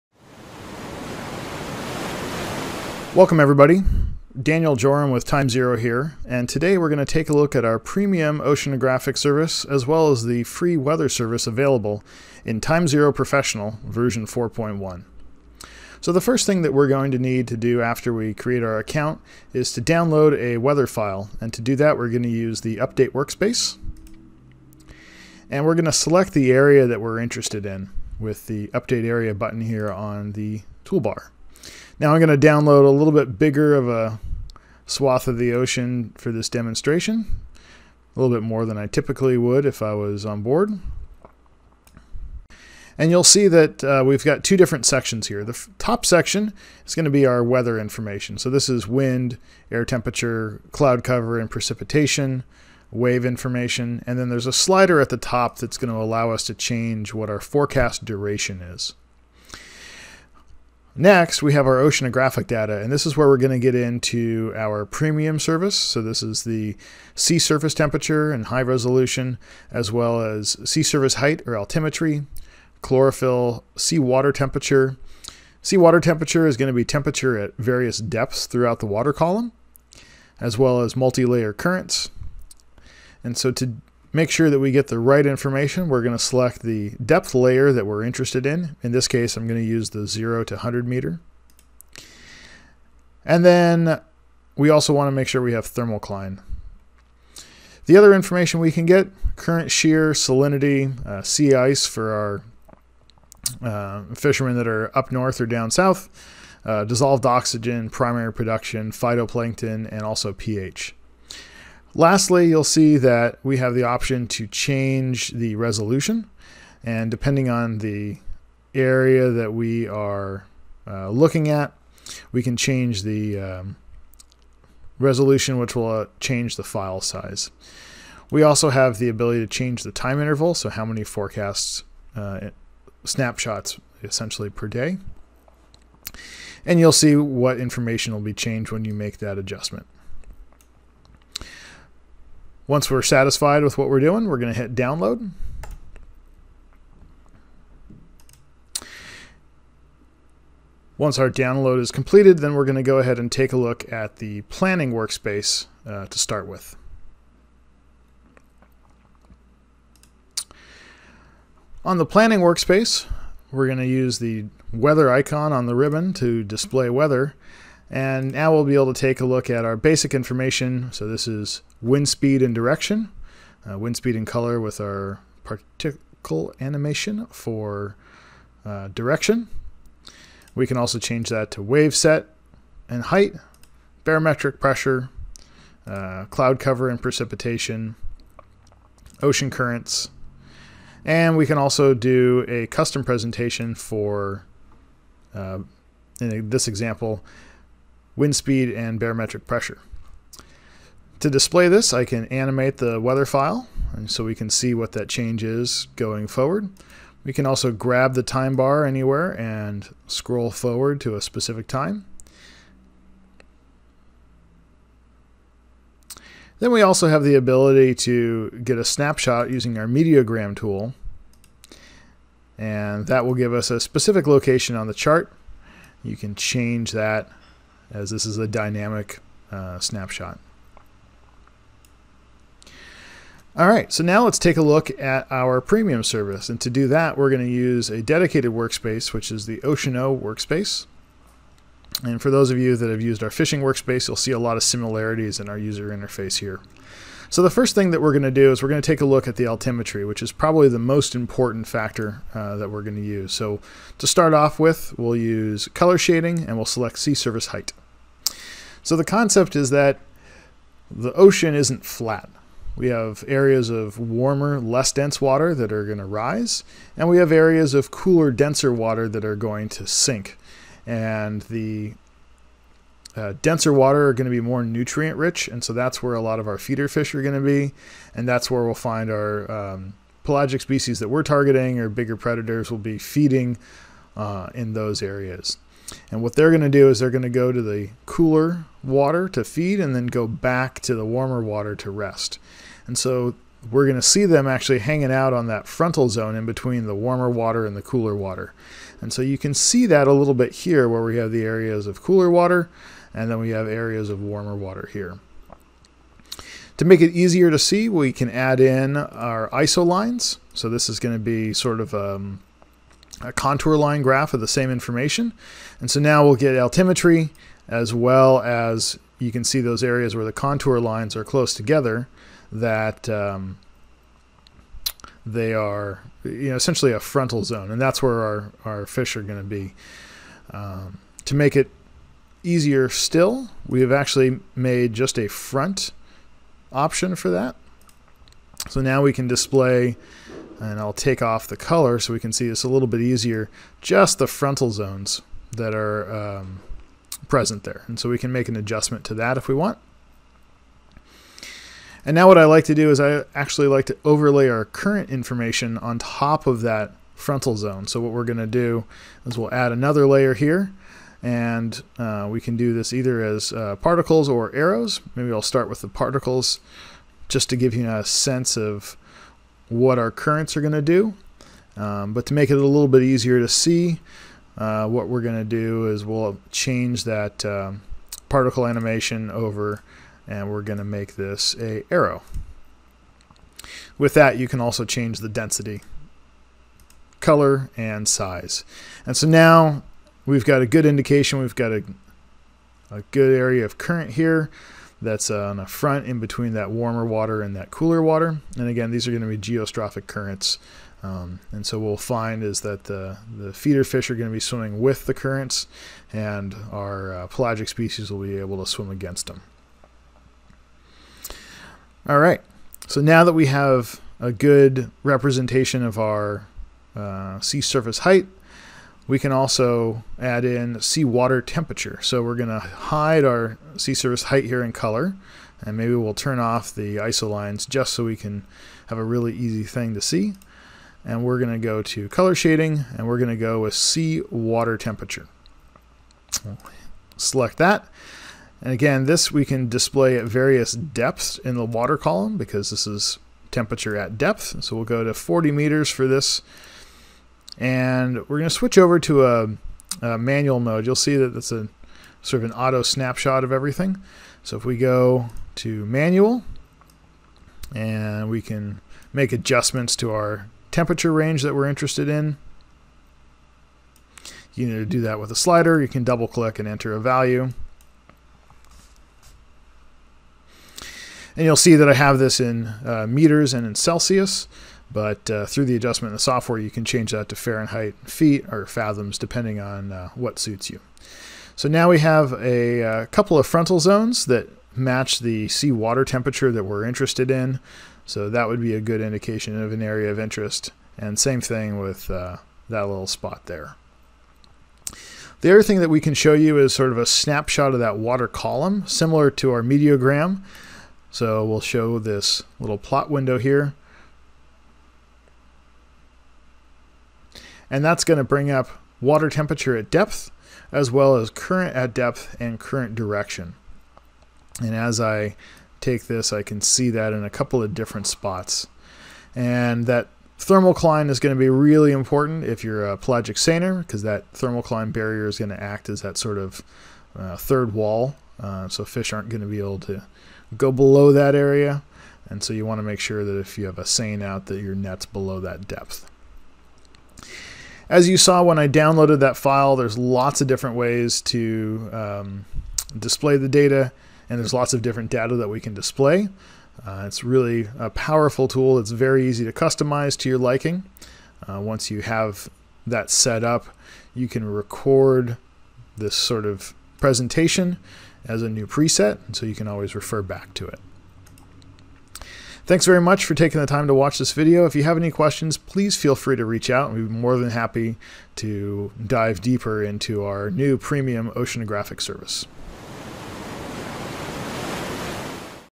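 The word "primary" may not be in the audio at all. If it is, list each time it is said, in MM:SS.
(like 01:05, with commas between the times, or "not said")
01:47.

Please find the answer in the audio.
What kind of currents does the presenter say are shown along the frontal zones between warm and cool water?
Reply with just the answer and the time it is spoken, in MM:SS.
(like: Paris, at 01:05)
geostrophic currents, at 06:39.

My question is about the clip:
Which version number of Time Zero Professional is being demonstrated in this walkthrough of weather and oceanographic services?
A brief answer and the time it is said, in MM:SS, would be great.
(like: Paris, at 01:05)
4.1, at 00:14.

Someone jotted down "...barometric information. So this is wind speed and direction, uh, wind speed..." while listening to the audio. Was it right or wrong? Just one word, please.
wrong.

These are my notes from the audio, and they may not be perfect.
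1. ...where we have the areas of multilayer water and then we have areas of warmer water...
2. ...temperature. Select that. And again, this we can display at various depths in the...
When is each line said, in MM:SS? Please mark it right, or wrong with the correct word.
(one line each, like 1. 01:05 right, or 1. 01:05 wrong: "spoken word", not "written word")
1. 05:00 wrong: "cooler", not "multilayer"
2. 07:14 right.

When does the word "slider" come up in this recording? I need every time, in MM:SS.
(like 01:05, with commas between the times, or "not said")
00:54, 07:45.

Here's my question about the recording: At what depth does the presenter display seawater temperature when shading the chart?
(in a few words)
40 meters.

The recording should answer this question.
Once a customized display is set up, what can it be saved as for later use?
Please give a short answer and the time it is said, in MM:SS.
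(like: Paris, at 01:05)
a new preset, at 09:18.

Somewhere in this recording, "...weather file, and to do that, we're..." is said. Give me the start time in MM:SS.
00:20.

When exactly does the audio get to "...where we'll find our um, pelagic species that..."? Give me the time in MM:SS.
04:38.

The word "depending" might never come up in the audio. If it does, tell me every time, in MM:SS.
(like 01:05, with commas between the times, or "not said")
01:57, 07:59.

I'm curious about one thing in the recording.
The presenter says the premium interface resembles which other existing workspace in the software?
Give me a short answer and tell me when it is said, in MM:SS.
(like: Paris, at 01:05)
fishing workspace, at 04:03.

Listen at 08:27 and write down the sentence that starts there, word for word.
and that's going to bring up water temperature at depth, as well as current at depth and current direction.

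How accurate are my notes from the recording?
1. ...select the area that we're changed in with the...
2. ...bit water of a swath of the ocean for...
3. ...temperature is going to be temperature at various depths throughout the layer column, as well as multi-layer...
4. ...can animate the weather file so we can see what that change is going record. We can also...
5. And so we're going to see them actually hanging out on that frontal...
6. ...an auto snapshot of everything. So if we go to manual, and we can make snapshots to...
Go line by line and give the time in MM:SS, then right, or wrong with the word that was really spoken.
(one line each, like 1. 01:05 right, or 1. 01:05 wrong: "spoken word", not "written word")
1. 00:25 wrong: "interested", not "changed"
2. 00:33 wrong: "bigger", not "water"
3. 01:16 wrong: "water", not "layer"
4. 03:22 wrong: "forward", not "record"
5. 04:52 right
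6. 07:32 wrong: "adjustments", not "snapshots".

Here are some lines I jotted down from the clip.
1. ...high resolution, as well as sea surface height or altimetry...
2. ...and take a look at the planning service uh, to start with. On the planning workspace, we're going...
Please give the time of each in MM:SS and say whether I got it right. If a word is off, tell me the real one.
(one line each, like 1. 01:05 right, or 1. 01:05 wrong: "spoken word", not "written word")
1. 01:08 right
2. 02:33 wrong: "workspace", not "service".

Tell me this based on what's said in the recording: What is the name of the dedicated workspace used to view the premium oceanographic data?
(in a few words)
Oceano workspace.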